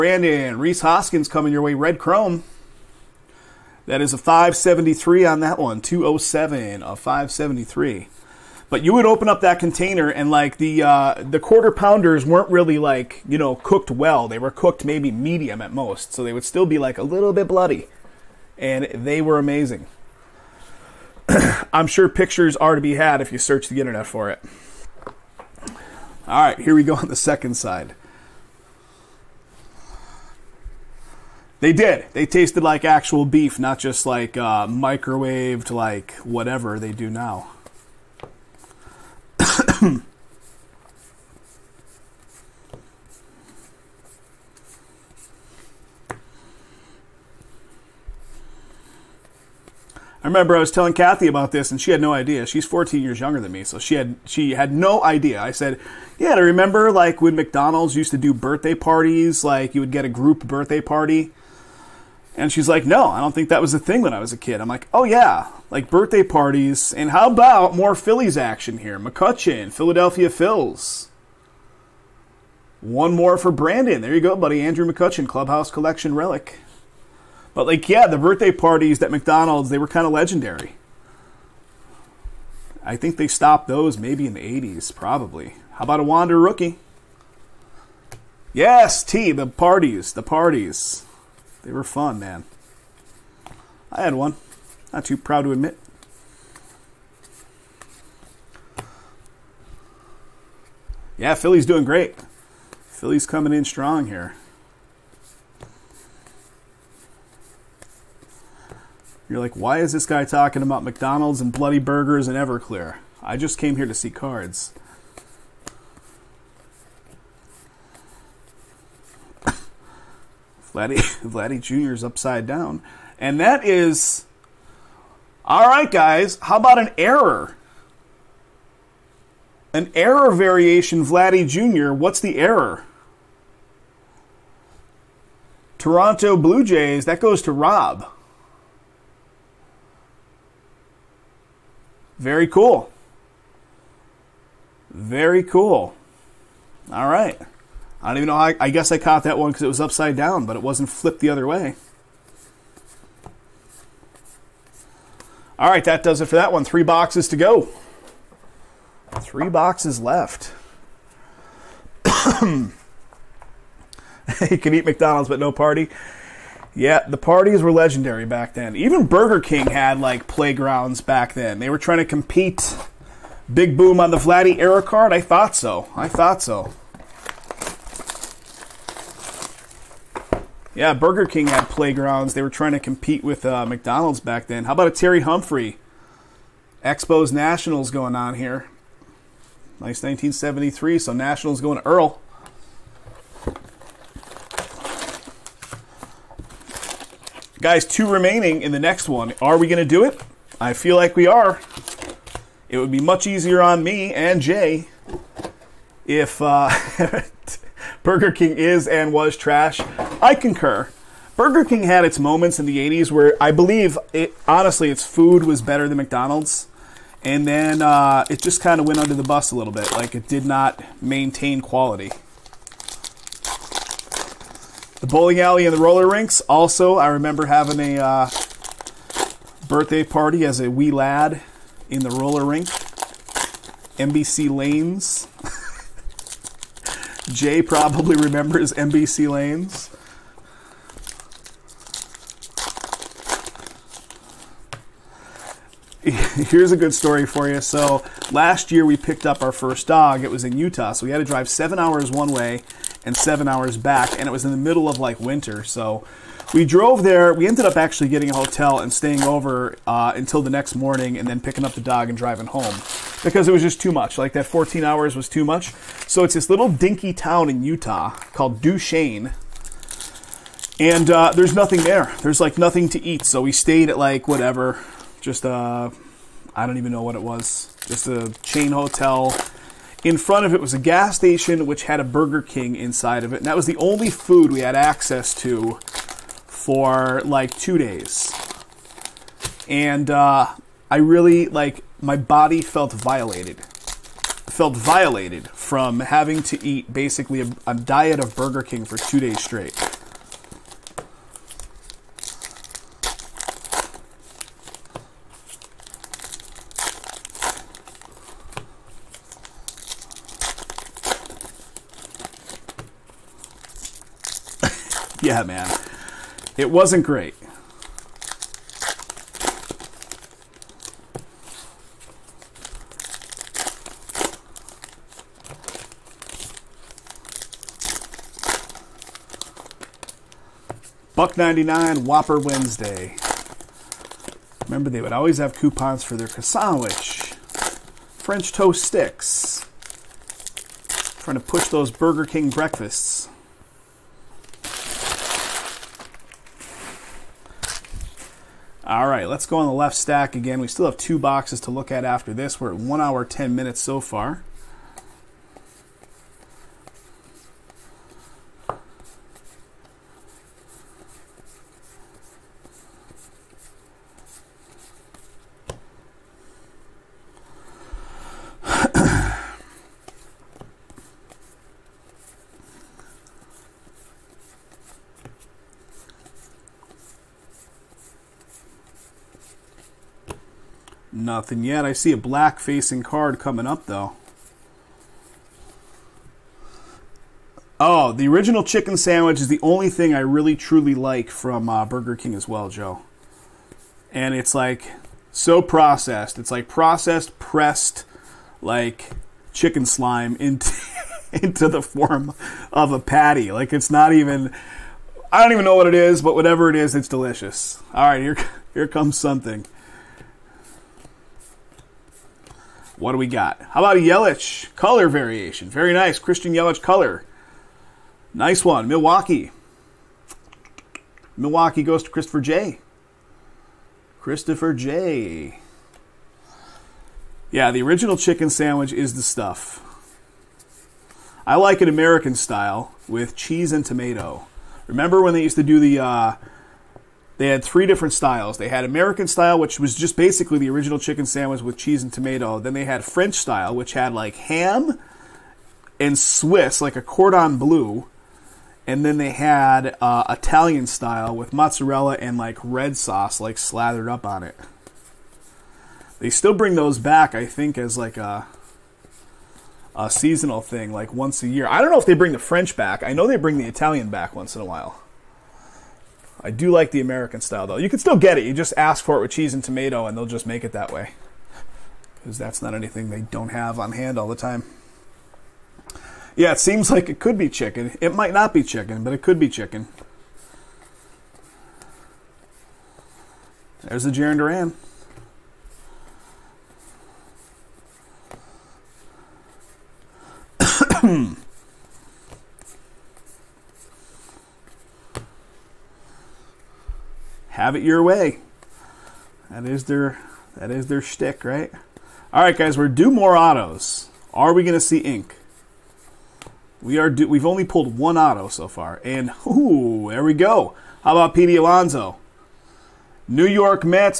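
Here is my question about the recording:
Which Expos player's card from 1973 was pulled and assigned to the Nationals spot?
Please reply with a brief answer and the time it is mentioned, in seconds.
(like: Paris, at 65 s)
Terry Humphrey, at 184 s.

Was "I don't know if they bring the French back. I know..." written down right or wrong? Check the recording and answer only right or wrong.
right.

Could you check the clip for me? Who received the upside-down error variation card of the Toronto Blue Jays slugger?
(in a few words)
Rob.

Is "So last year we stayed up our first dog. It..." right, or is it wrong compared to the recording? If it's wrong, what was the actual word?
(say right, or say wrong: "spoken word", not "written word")
wrong: "picked", not "stayed".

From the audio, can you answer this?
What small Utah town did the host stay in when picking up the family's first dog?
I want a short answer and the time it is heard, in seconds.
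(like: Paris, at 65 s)
Duchesne, at 268 s.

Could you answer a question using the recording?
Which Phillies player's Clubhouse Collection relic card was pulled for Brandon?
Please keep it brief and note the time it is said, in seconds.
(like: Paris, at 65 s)
Andrew McCutchen, at 74 s.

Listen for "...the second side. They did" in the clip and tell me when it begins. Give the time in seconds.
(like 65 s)
27 s.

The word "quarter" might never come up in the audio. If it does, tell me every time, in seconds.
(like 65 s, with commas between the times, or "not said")
11 s.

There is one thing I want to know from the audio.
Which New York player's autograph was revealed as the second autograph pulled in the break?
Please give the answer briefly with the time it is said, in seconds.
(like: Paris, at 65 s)
Pete Alonso, at 511 s.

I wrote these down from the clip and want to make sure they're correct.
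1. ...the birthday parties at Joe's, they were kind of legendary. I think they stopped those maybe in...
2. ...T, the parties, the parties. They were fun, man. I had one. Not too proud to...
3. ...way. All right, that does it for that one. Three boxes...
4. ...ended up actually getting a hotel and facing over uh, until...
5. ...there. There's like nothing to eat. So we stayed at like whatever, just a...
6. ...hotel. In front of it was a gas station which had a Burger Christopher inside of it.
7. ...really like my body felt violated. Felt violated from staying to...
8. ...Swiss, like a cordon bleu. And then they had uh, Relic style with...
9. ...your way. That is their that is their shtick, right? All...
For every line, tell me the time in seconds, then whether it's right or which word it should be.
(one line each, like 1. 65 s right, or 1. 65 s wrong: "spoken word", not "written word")
1. 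78 s wrong: "McDonald", not "Joe"
2. 89 s right
3. 151 s right
4. 257 s wrong: "staying", not "facing"
5. 271 s right
6. 278 s wrong: "King", not "Christopher"
7. 290 s wrong: "having", not "staying"
8. 446 s wrong: "Italian", not "Relic"
9. 497 s right.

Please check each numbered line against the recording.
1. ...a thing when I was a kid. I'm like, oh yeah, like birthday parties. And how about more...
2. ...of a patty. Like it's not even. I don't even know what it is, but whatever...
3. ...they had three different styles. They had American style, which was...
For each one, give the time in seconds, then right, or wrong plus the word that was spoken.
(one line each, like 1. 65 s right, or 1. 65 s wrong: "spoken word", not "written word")
1. 63 s right
2. 402 s right
3. 437 s right.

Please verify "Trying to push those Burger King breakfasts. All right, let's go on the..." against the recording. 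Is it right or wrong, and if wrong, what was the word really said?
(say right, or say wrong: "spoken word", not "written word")
right.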